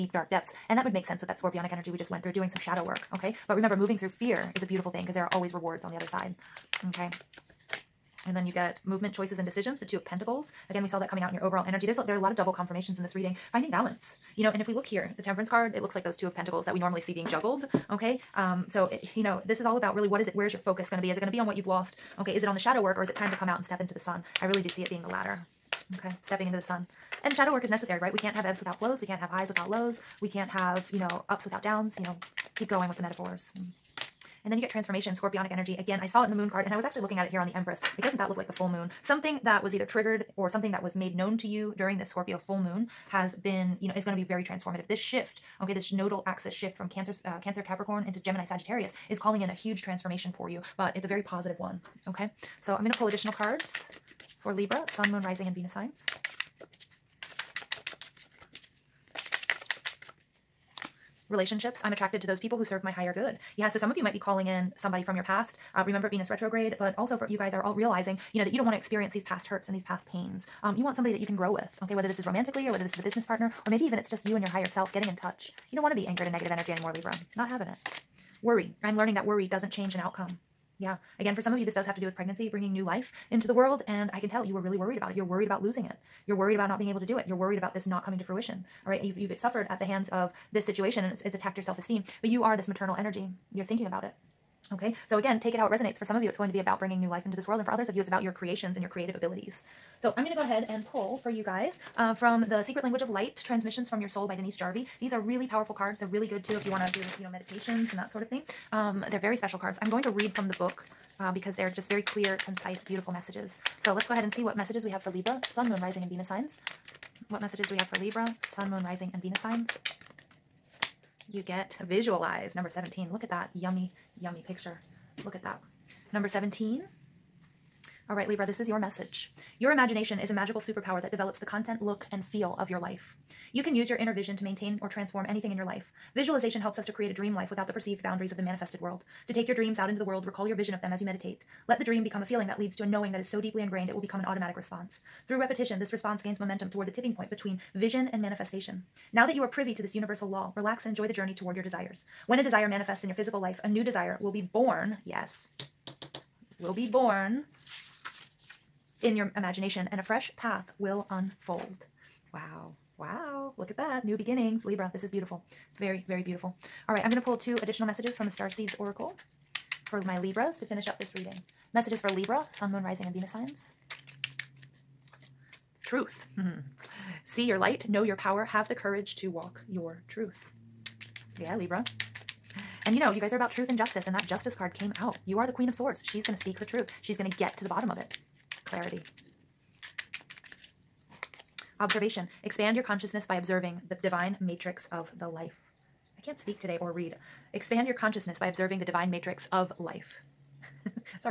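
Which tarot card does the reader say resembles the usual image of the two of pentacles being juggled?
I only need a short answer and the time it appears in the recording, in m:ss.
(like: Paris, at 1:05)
Temperance, at 0:15.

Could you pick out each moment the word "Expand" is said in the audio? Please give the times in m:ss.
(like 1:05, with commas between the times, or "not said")
3:12, 3:17.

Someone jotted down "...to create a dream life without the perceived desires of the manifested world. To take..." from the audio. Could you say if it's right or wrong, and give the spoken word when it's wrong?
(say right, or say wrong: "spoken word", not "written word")
wrong: "boundaries", not "desires".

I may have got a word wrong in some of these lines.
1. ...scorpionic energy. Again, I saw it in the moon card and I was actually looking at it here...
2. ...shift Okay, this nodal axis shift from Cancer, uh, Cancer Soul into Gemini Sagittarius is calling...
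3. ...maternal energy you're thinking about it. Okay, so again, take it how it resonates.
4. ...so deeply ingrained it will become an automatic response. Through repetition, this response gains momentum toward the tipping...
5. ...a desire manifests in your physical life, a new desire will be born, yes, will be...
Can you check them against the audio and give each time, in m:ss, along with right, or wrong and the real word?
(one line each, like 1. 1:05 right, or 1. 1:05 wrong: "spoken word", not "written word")
1. 0:35 right
2. 0:44 wrong: "Capricorn", not "Soul"
3. 1:32 right
4. 2:23 right
5. 2:32 right.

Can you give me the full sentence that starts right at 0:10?
Again, we saw that coming out in your overall energy.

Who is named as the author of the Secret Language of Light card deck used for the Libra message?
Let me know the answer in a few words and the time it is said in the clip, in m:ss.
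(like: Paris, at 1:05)
Denise Jarvie, at 1:44.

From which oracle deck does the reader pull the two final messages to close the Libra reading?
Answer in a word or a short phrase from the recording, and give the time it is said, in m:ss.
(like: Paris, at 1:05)
Star Seeds Oracle, at 2:48.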